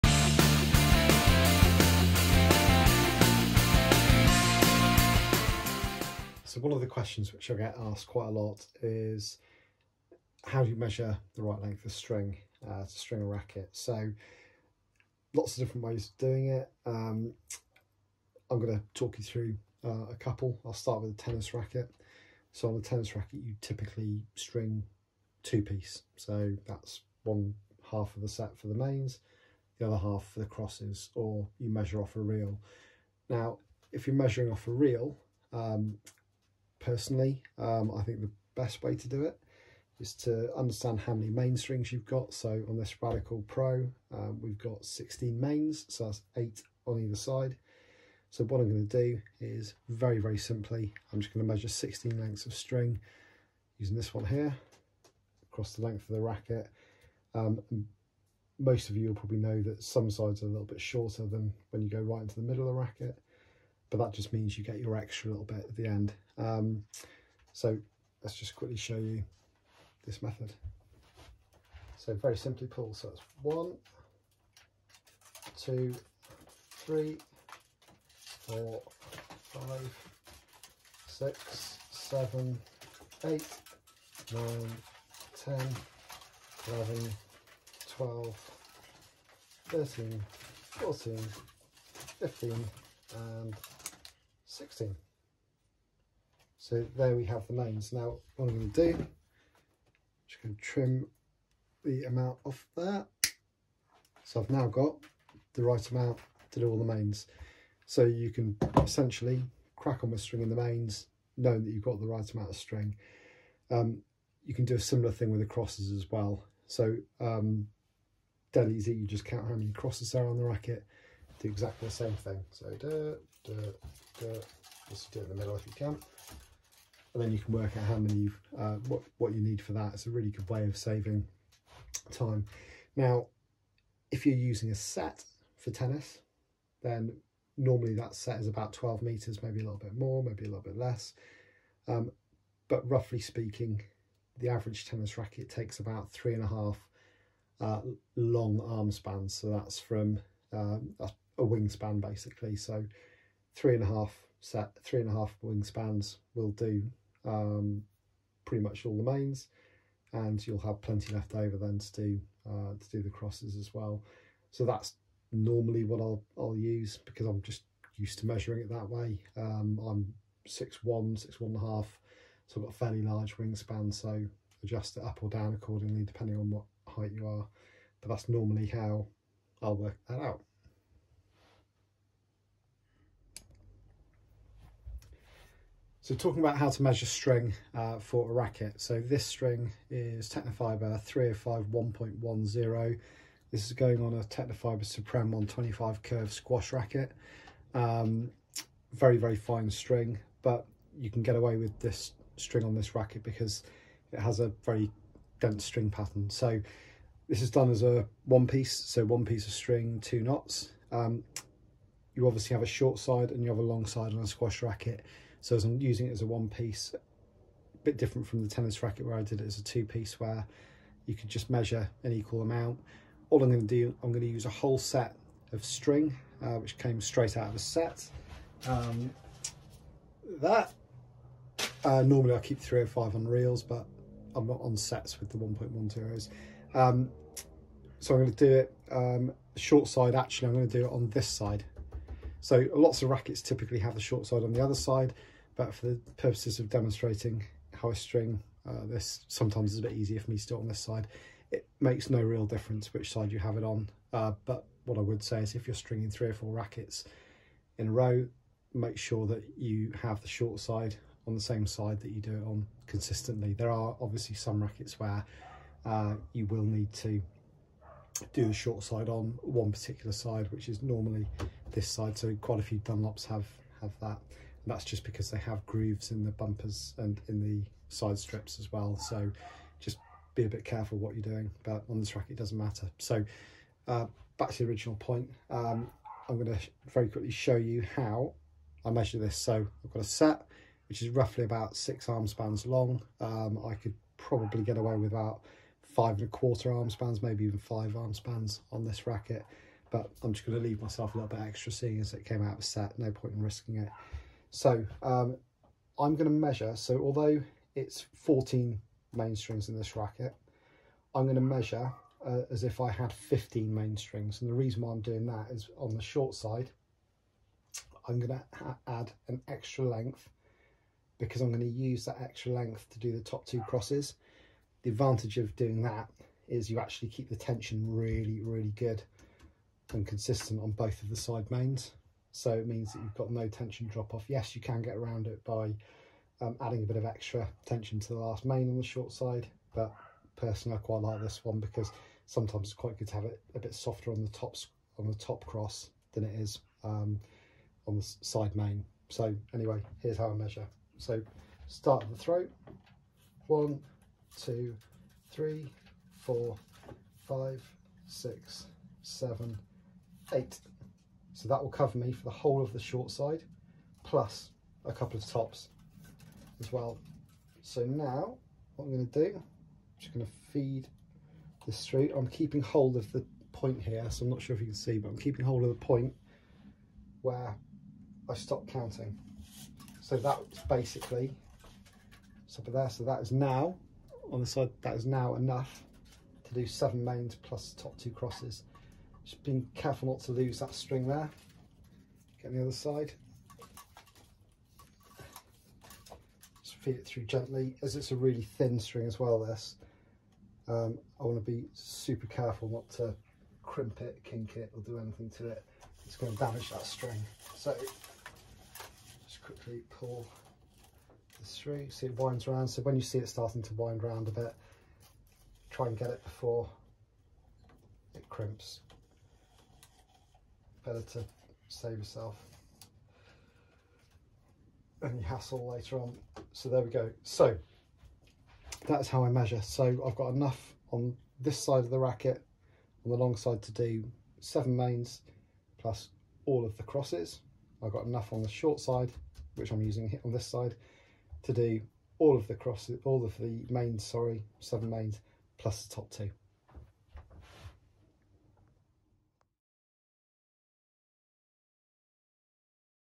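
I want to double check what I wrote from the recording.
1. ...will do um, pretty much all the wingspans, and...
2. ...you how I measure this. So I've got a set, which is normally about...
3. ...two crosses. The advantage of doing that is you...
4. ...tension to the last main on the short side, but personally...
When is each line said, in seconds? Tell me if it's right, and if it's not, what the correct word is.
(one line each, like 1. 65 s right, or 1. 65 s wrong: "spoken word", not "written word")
1. 156 s wrong: "mains", not "wingspans"
2. 287 s wrong: "roughly", not "normally"
3. 323 s right
4. 337 s right.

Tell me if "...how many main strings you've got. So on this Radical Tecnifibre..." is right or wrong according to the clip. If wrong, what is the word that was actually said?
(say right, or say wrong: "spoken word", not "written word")
wrong: "Pro", not "Tecnifibre".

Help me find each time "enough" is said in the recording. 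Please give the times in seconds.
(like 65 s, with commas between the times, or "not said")
385 s, 430 s, 438 s.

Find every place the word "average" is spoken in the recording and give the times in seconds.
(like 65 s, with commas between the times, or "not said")
144 s.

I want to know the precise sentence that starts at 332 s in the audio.
So it means that you've got no tension drop off.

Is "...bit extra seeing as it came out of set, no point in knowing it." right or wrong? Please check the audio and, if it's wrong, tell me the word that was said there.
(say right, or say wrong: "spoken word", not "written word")
wrong: "risking", not "knowing".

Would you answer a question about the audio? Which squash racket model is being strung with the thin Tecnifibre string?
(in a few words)
Tecnifibre Supreme 125 curve.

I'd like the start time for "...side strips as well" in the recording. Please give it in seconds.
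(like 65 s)
277 s.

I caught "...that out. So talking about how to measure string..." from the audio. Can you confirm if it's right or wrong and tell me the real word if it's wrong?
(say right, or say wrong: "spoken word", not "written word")
right.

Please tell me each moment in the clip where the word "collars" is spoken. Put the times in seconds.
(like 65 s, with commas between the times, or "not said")
not said.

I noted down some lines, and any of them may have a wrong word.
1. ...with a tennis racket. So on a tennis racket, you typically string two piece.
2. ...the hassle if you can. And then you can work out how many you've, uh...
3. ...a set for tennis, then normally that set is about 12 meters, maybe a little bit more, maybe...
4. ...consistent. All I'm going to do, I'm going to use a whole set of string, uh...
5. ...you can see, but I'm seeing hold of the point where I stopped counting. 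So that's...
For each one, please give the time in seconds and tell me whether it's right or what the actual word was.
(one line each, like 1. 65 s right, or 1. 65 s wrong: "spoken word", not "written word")
1. 21 s right
2. 125 s wrong: "middle", not "hassle"
3. 134 s right
4. 222 s wrong: "amount", not "consistent"
5. 374 s wrong: "keeping", not "seeing".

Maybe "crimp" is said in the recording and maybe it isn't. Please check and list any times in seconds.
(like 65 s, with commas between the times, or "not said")
403 s, 418 s.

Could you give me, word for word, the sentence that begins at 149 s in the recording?
So that's from um, that's a wingspan basically.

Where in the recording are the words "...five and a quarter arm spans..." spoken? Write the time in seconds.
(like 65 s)
295 s.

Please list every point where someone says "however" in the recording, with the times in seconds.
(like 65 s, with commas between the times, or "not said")
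not said.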